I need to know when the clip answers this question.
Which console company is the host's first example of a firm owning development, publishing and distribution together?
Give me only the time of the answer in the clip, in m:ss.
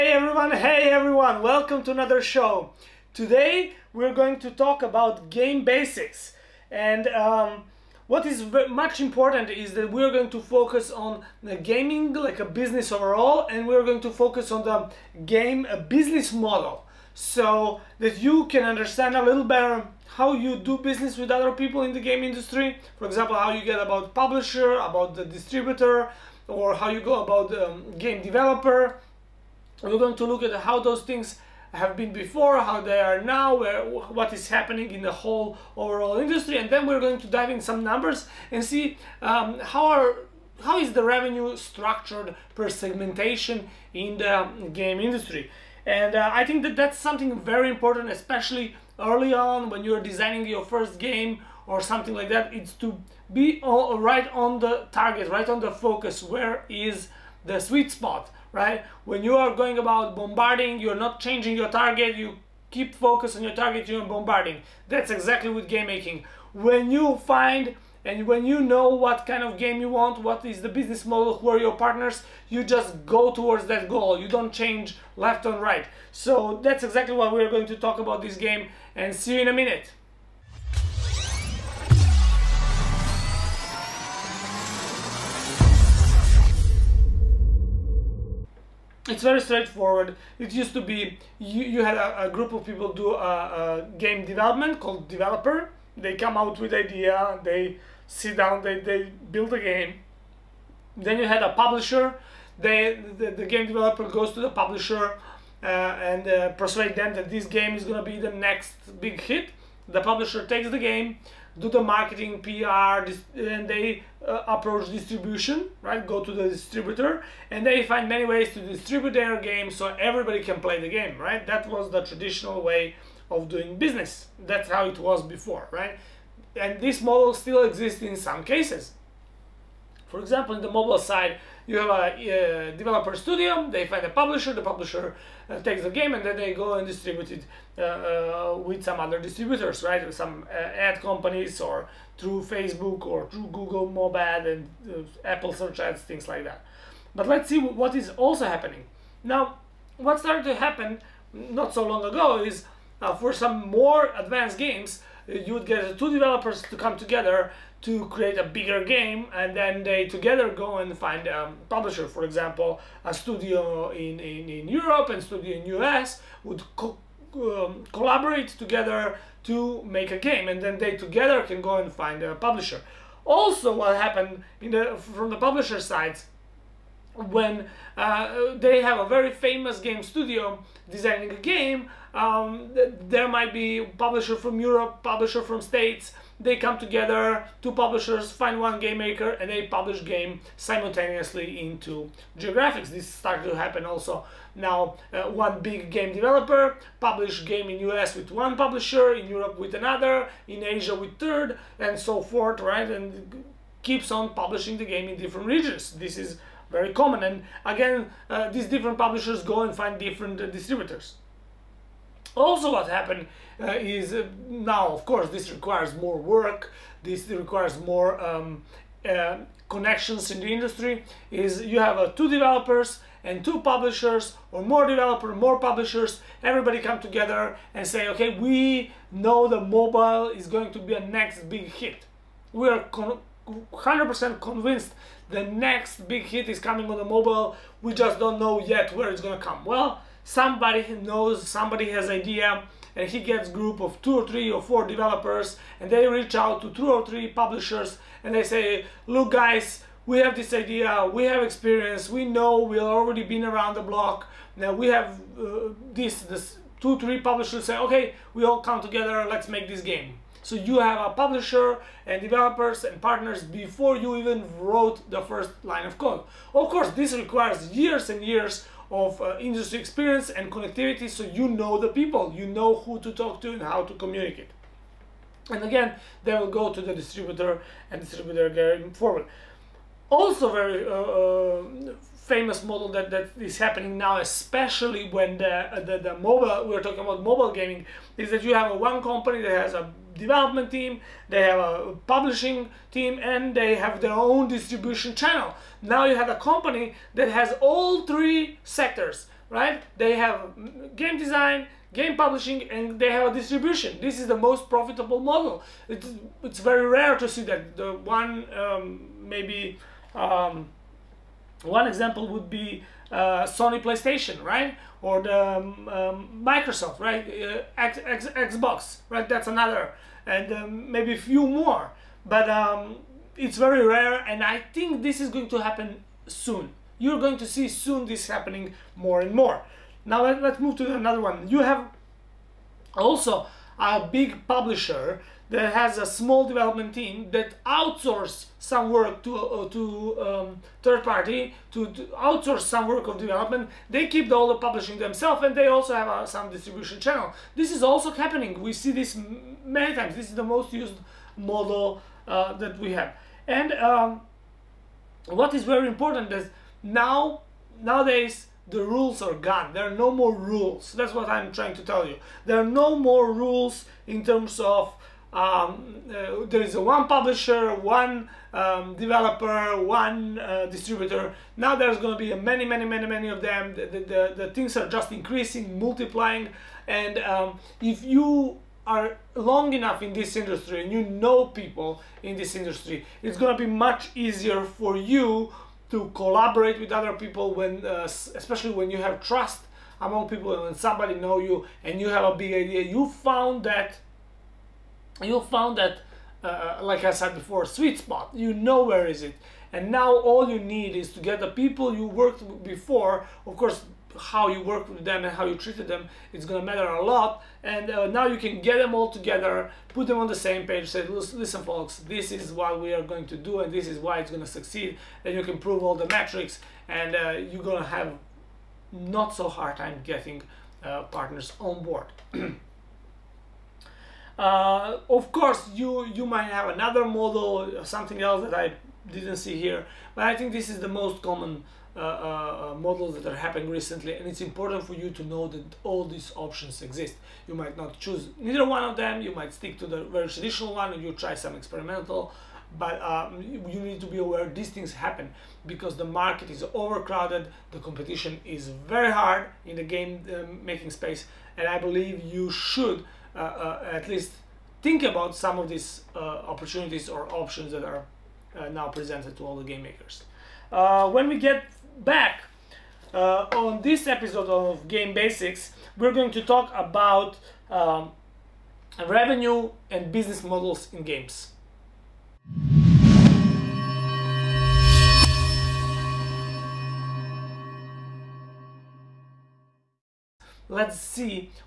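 5:13.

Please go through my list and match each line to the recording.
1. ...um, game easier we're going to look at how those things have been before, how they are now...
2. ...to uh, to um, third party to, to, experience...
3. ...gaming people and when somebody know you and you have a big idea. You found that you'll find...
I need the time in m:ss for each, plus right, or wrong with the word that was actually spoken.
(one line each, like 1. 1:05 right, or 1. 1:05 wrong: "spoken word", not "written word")
1. 0:27 wrong: "developer", not "easier"
2. 5:39 wrong: "outsource", not "experience"
3. 6:29 wrong: "among", not "gaming".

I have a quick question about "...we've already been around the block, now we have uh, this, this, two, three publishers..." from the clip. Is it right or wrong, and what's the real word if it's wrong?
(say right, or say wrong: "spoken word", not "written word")
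right.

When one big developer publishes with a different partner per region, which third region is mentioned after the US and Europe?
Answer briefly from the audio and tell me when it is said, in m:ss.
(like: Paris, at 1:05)
Asia, at 3:20.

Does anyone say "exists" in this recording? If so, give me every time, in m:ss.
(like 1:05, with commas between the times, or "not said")
2:07, 7:16.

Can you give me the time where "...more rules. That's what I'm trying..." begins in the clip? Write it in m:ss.
6:00.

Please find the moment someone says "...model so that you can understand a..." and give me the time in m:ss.
0:16.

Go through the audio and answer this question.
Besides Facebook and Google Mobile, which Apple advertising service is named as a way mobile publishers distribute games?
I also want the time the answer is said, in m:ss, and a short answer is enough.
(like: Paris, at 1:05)
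Apple search ads, at 2:25.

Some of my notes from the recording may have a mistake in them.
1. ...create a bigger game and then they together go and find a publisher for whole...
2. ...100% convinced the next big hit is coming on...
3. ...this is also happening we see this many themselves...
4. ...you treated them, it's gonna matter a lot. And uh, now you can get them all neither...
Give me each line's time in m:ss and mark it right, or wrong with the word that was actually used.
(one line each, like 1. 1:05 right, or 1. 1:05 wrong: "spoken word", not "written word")
1. 2:38 wrong: "example", not "whole"
2. 3:53 right
3. 5:47 wrong: "times", not "themselves"
4. 6:45 wrong: "together", not "neither".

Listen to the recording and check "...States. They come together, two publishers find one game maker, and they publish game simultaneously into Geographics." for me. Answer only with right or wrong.
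right.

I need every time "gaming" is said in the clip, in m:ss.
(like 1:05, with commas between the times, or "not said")
0:11, 4:47.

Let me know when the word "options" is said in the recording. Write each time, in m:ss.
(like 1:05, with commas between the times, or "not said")
7:16, 7:37.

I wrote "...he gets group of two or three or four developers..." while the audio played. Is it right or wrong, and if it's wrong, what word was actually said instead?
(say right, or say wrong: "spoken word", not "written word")
right.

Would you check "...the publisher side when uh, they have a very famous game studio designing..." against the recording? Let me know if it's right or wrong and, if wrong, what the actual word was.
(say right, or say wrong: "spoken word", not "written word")
right.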